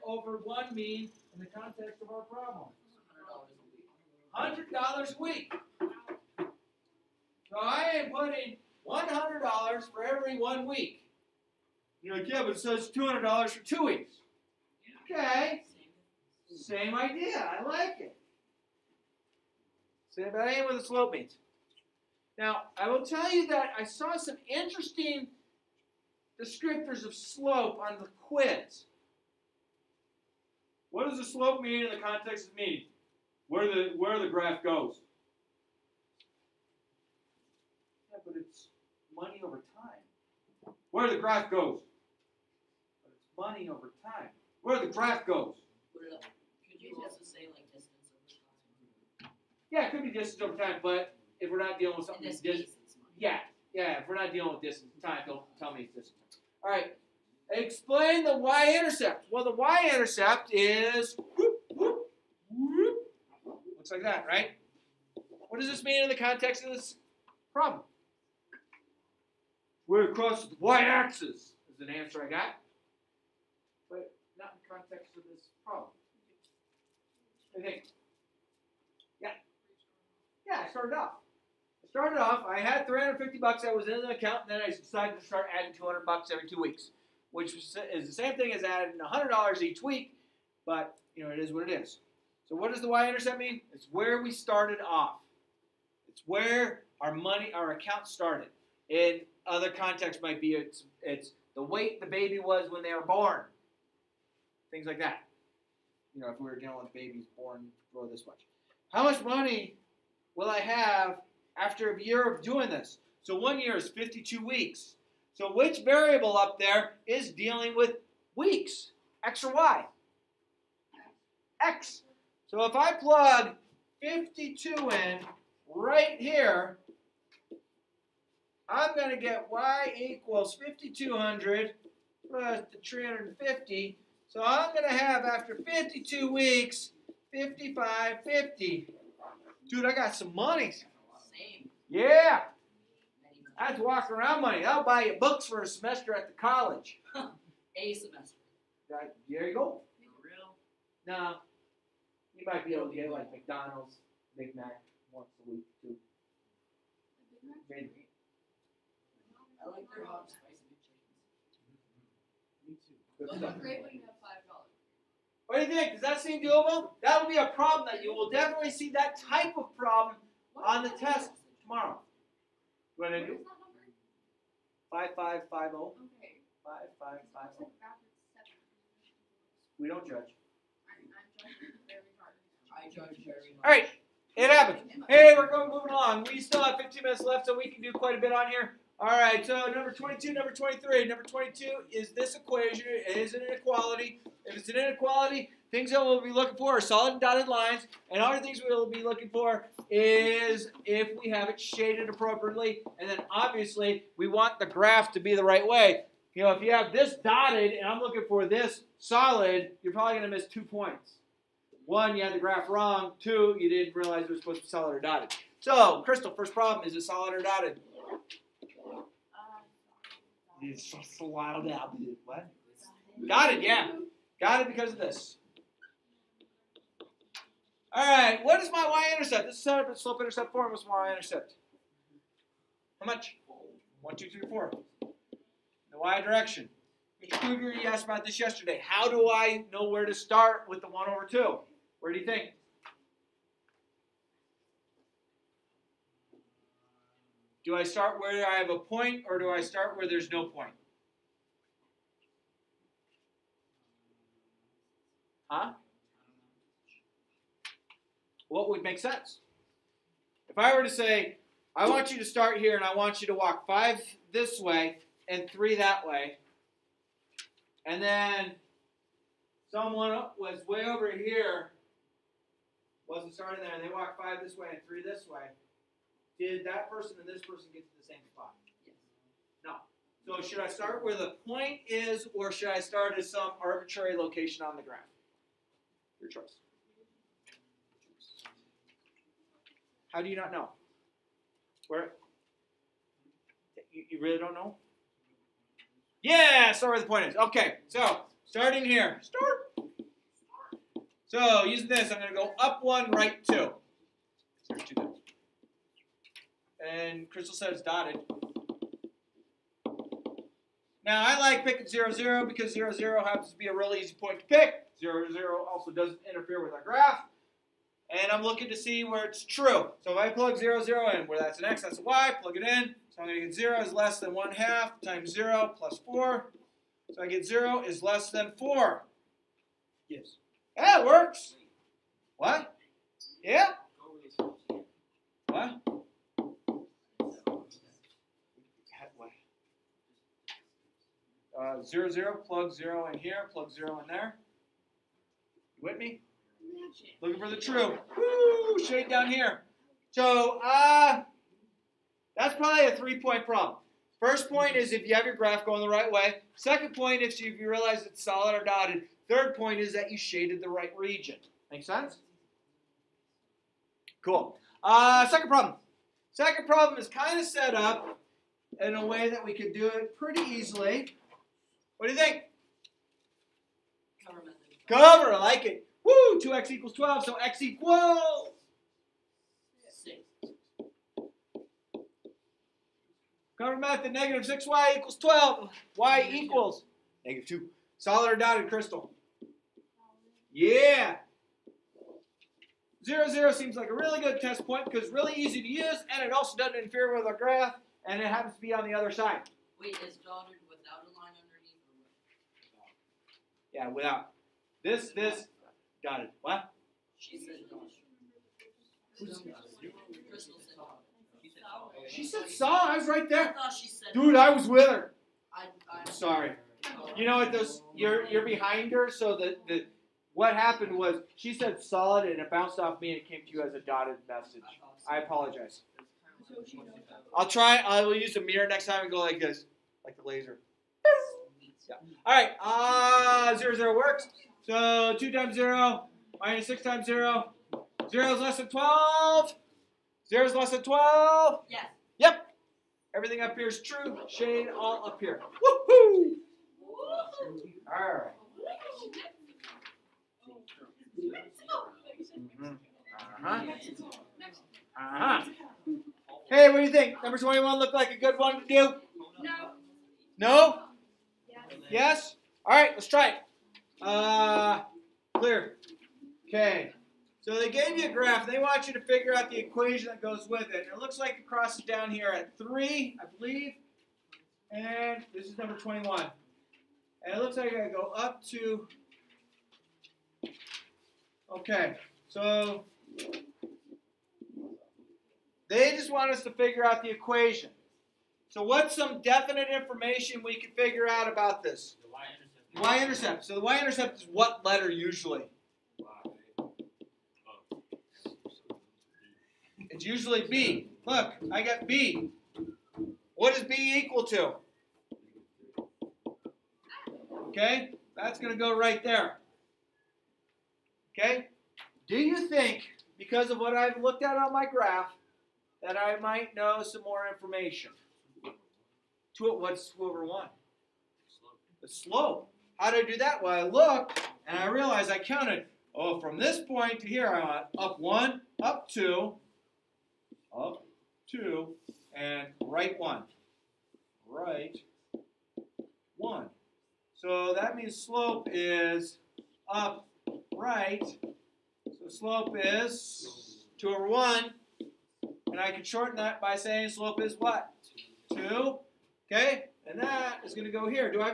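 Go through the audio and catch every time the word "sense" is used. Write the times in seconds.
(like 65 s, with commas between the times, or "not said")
258 s, 361 s.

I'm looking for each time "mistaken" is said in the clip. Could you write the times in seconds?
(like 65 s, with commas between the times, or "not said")
not said.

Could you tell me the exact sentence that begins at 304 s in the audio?
Start two and Crystal it's dotted.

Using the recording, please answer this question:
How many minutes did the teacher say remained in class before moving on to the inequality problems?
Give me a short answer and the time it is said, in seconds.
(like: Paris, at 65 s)
15, at 186 s.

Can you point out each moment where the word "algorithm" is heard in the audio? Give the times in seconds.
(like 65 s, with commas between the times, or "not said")
not said.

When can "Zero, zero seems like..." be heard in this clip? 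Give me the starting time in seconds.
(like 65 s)
393 s.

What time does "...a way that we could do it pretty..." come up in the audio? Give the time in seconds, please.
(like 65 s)
368 s.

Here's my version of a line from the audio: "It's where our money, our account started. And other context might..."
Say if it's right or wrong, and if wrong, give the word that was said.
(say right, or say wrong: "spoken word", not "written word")
right.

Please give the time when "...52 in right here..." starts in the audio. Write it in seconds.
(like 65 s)
124 s.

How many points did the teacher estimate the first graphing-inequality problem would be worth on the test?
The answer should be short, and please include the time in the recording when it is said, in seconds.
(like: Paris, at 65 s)
3, at 352 s.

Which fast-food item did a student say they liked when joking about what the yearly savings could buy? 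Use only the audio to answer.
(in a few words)
hot spicy McChickens.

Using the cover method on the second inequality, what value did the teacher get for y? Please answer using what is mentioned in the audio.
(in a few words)
-2.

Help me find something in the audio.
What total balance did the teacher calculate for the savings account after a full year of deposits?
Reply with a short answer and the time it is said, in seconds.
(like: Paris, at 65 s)
5550, at 137 s.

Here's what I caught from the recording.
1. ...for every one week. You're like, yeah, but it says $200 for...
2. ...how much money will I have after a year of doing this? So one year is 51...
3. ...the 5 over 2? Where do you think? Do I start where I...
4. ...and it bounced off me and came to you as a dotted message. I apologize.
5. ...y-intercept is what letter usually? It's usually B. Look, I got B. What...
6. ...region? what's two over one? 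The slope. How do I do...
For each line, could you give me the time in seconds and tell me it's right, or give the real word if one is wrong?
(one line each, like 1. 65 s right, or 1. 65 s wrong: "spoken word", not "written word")
1. 9 s right
2. 108 s wrong: "52", not "51"
3. 240 s wrong: "1", not "5"
4. 422 s right
5. 493 s right
6. 517 s wrong: "information", not "region".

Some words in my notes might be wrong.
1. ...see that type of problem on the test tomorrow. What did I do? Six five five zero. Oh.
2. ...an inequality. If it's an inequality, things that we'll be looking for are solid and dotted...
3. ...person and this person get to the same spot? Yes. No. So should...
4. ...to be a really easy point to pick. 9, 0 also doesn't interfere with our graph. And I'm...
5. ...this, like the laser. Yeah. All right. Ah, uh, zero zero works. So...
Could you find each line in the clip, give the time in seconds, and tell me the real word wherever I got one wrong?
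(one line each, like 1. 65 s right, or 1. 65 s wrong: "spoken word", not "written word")
1. 168 s wrong: "Five", not "Six"
2. 193 s right
3. 276 s right
4. 313 s wrong: "0", not "9"
5. 429 s right.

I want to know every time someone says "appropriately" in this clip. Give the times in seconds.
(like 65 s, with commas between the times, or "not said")
202 s.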